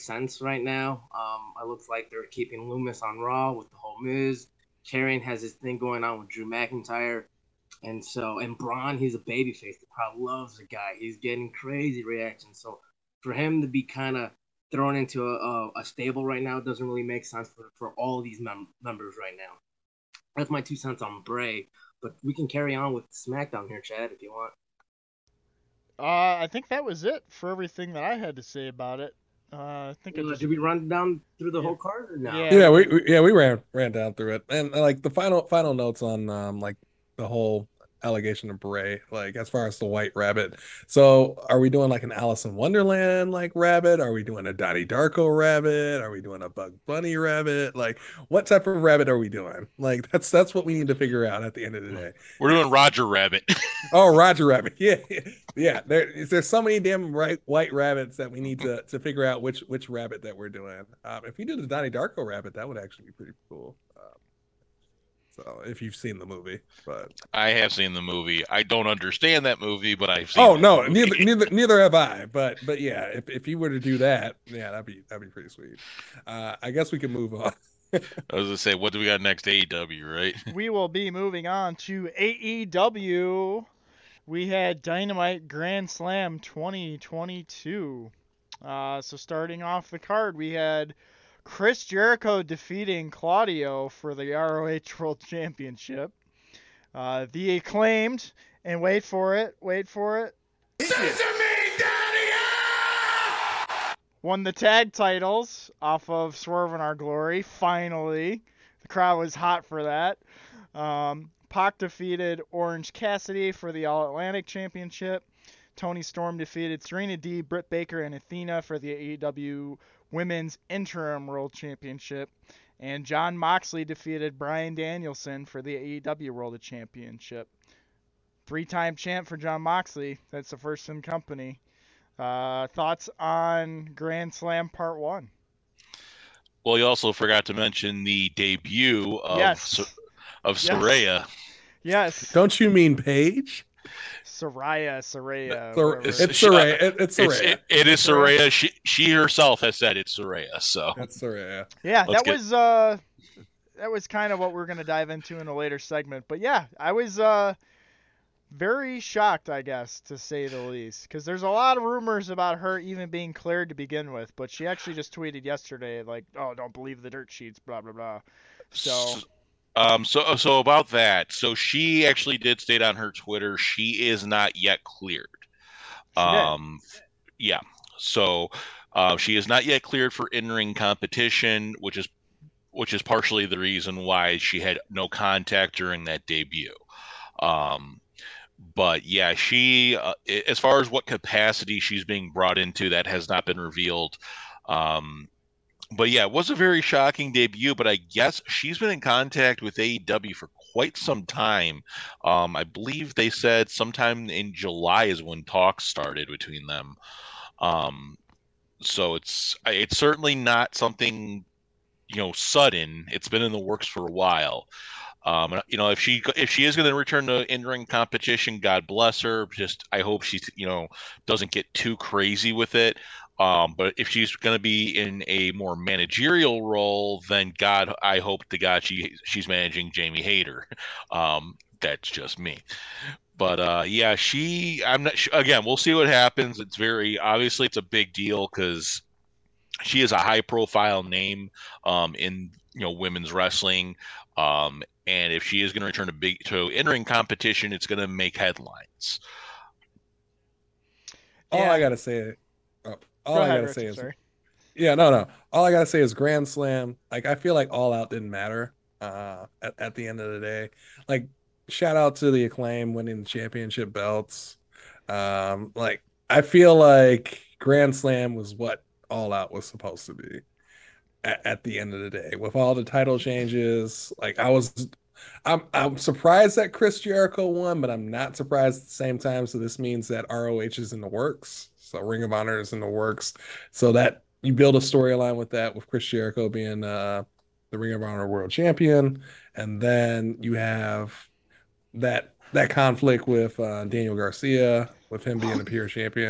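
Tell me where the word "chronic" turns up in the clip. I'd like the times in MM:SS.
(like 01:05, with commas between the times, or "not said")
not said.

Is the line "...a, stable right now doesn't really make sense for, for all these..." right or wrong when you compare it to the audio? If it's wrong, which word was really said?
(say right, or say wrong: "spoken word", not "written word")
right.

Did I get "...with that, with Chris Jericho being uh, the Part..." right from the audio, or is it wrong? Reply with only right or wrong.
wrong.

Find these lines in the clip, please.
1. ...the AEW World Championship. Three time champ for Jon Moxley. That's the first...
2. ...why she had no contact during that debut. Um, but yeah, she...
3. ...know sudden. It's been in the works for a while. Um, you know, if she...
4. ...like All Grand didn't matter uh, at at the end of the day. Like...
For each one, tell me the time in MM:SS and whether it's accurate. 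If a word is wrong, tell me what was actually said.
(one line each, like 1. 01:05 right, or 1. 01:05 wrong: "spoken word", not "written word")
1. 02:05 right
2. 03:03 right
3. 03:32 right
4. 04:17 wrong: "Out", not "Grand".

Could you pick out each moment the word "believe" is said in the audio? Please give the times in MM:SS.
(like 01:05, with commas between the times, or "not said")
02:46, 03:22.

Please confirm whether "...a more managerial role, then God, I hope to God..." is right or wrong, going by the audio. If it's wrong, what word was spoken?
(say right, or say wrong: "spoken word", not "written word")
right.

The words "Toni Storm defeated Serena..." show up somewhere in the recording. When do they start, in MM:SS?
01:55.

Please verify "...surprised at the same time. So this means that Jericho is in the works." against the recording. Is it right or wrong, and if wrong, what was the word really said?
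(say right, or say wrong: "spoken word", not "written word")
wrong: "ROH", not "Jericho".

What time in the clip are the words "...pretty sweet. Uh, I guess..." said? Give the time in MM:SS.
01:15.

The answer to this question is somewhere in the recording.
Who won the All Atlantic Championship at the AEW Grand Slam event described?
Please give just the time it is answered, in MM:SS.
01:51.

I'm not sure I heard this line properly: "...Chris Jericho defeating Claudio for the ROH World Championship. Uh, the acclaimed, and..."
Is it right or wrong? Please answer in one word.
right.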